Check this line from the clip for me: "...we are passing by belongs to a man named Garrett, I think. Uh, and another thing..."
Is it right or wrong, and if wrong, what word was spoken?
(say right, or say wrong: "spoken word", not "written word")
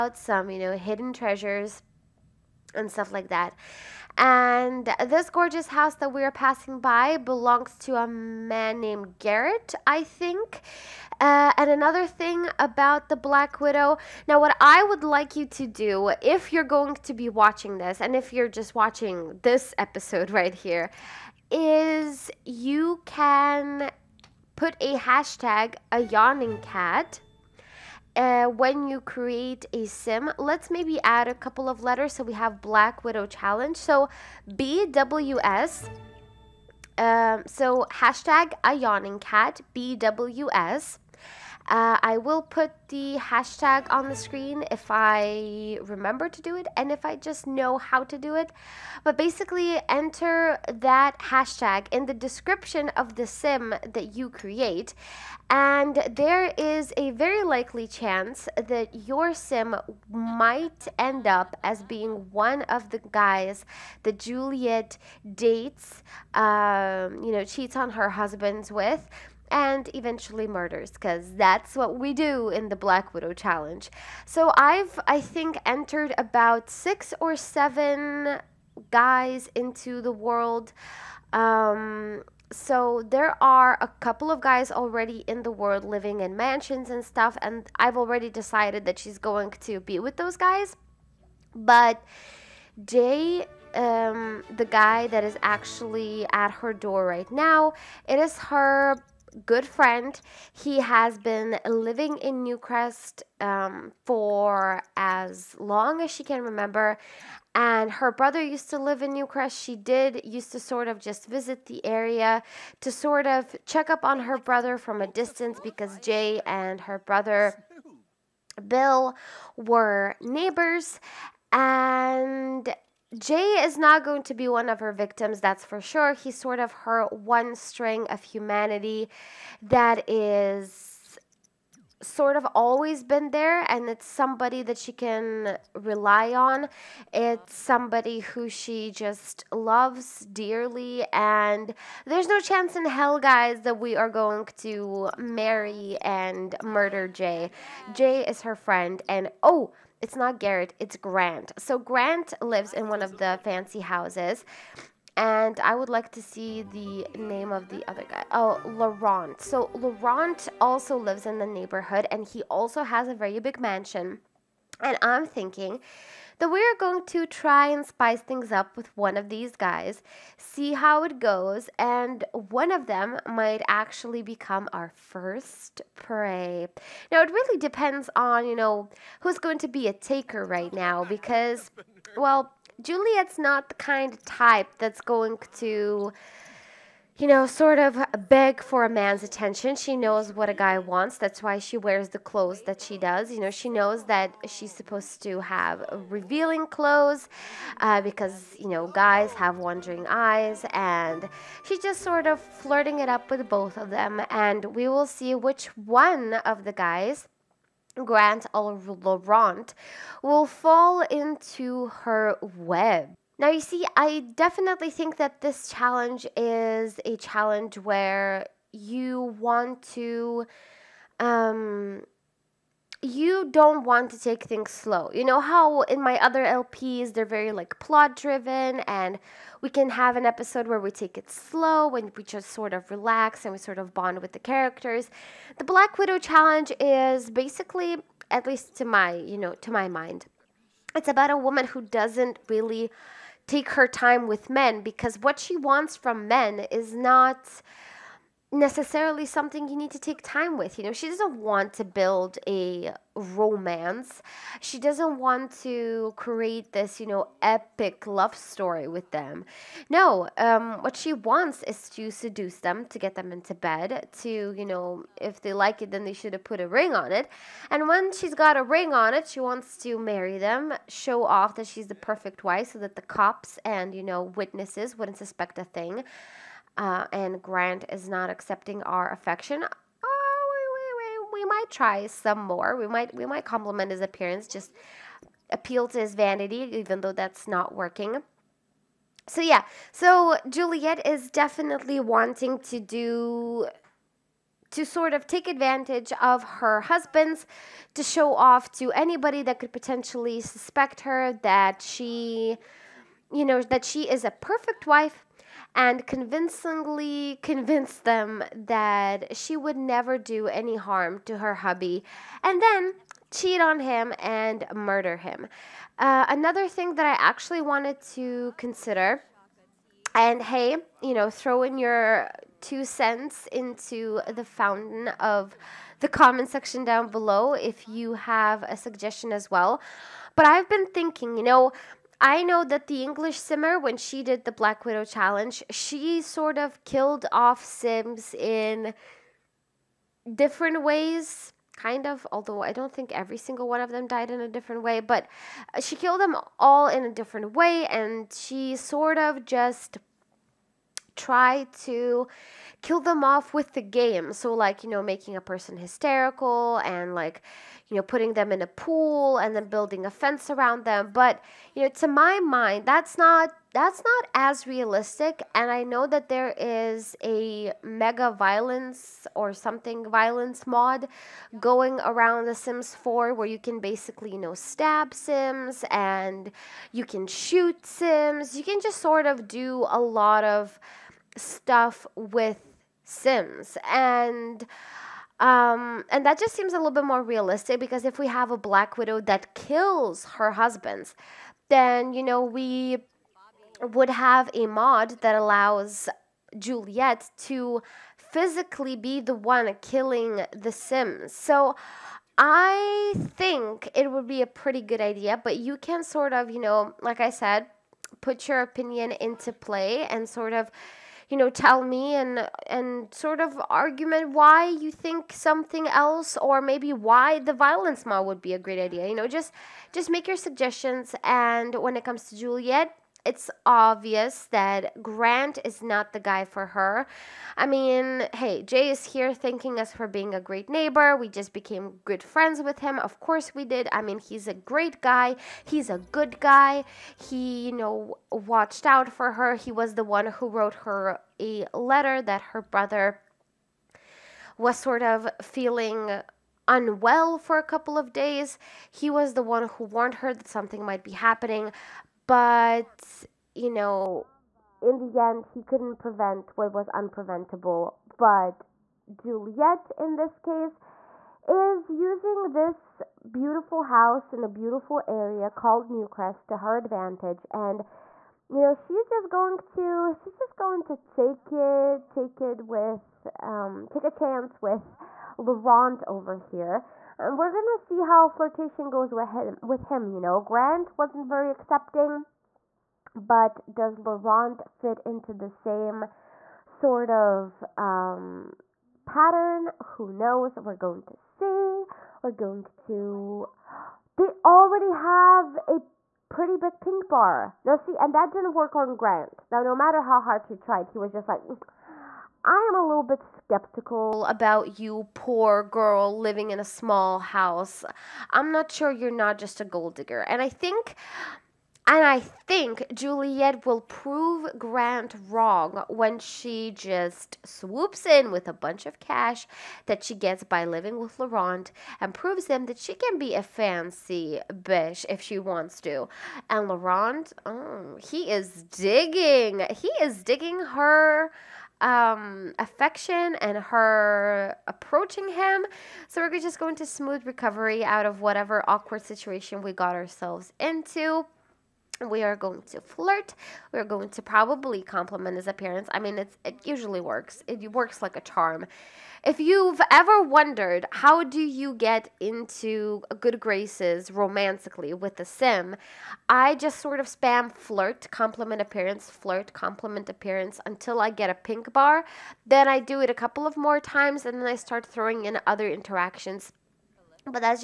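right.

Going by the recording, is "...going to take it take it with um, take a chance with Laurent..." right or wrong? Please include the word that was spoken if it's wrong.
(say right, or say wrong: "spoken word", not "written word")
right.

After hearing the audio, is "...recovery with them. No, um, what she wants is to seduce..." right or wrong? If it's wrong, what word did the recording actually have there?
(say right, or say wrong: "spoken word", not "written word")
wrong: "story", not "recovery".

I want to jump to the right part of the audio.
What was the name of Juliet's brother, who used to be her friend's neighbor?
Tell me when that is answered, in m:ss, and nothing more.
1:58.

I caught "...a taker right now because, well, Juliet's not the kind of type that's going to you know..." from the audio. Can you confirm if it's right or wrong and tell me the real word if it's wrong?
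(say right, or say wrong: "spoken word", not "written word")
right.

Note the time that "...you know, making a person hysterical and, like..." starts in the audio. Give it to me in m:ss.
5:54.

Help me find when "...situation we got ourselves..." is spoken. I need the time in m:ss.
8:59.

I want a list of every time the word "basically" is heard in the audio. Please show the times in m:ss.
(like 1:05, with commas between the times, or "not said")
0:49, 3:57, 6:13.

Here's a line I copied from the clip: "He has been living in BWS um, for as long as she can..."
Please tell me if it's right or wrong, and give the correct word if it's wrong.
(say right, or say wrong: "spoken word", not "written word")
wrong: "Newcrest", not "BWS".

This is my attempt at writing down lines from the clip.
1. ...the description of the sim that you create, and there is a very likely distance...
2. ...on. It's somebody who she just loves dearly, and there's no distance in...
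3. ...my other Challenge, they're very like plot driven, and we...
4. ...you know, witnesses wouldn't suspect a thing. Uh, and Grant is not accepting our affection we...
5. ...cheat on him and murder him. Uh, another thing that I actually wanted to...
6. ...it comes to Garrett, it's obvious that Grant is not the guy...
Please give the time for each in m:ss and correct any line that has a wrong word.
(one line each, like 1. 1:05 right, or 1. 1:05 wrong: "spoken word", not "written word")
1. 0:52 wrong: "chance", not "distance"
2. 2:16 wrong: "chance", not "distance"
3. 3:46 wrong: "LPs", not "Challenge"
4. 4:33 right
5. 5:13 right
6. 7:01 wrong: "Juliet", not "Garrett".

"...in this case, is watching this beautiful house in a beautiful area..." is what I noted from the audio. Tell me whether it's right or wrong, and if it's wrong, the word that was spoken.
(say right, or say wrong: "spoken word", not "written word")
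wrong: "using", not "watching".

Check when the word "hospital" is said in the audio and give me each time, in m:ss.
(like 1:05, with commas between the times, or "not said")
not said.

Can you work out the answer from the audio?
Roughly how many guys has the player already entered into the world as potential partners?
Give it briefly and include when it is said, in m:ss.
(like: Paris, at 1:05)
6 or 7, at 1:16.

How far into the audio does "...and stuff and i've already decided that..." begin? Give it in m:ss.
1:26.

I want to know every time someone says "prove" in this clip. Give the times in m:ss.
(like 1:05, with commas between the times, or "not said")
8:33, 8:42.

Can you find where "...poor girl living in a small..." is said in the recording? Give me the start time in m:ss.
8:25.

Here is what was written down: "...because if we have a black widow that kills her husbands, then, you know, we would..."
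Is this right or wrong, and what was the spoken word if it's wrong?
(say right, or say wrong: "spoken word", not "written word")
right.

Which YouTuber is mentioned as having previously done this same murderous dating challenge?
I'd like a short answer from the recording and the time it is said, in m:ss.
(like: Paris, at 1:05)
The English Simmer, at 5:32.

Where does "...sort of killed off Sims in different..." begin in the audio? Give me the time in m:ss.
5:36.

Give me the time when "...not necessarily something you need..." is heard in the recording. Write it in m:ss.
4:06.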